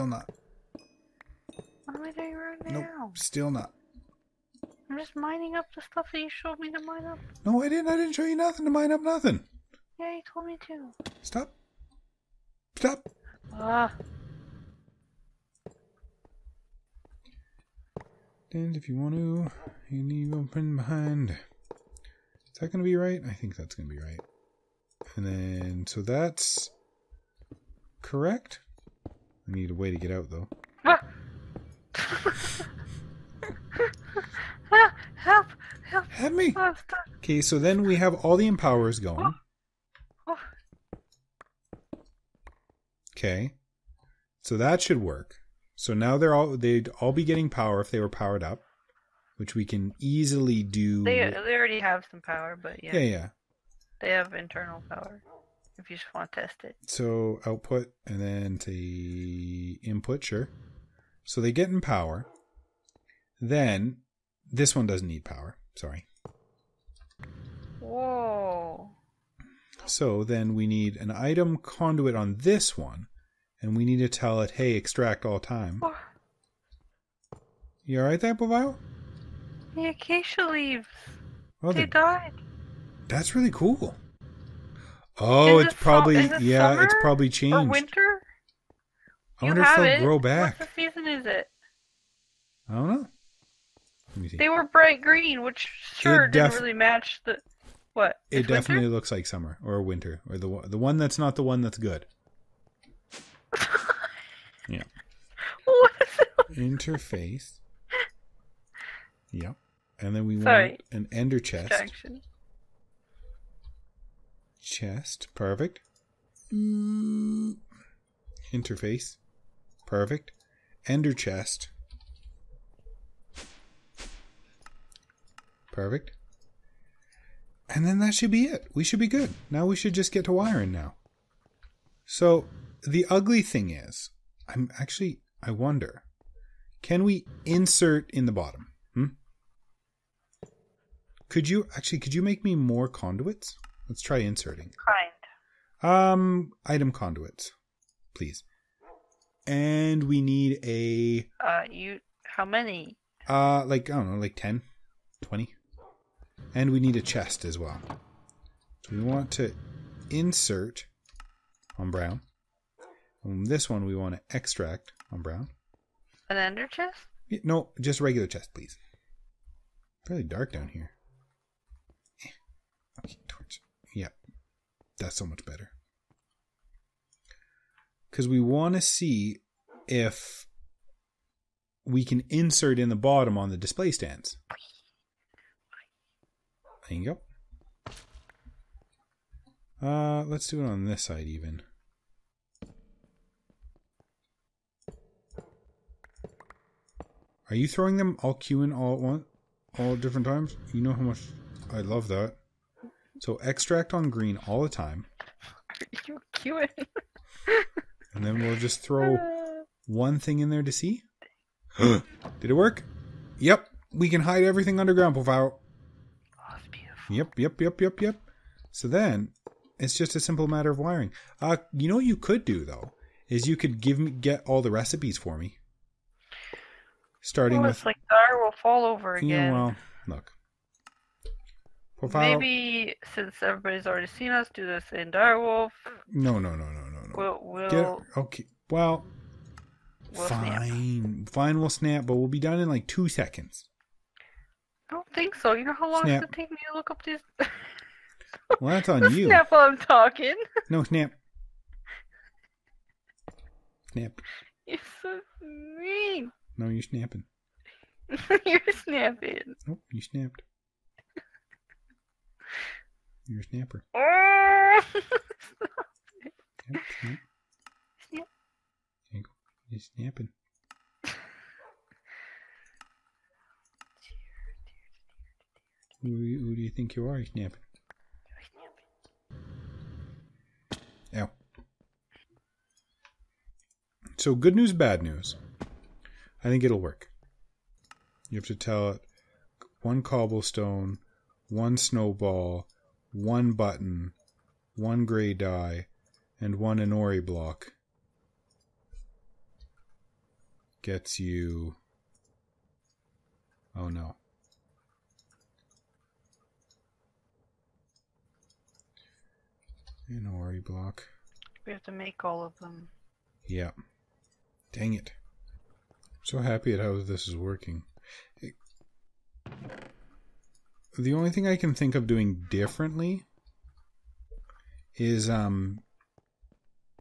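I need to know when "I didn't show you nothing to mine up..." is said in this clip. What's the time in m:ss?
0:07.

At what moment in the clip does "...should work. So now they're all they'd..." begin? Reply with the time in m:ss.
0:44.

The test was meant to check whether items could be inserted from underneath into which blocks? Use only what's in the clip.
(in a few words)
display stands.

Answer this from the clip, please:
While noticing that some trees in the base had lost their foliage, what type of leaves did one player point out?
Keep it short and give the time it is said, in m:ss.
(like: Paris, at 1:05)
acacia leaves, at 1:19.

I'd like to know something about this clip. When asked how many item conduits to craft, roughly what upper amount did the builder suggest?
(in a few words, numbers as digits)
20.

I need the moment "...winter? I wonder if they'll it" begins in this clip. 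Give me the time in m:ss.
1:27.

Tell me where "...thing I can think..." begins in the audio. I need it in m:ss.
5:21.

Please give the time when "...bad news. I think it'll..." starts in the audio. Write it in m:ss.
4:44.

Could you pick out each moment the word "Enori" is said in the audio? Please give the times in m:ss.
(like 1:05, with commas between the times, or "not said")
4:56, 5:10.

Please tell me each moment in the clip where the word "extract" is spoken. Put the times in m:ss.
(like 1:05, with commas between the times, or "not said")
1:14, 2:44, 3:23.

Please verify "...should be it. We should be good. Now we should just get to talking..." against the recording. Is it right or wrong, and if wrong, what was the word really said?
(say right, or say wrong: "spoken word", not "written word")
wrong: "wiring", not "talking".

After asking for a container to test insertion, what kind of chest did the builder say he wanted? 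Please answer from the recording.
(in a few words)
regular chest.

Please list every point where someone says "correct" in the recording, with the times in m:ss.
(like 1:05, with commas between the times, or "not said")
0:28.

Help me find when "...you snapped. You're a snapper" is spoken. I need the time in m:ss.
4:19.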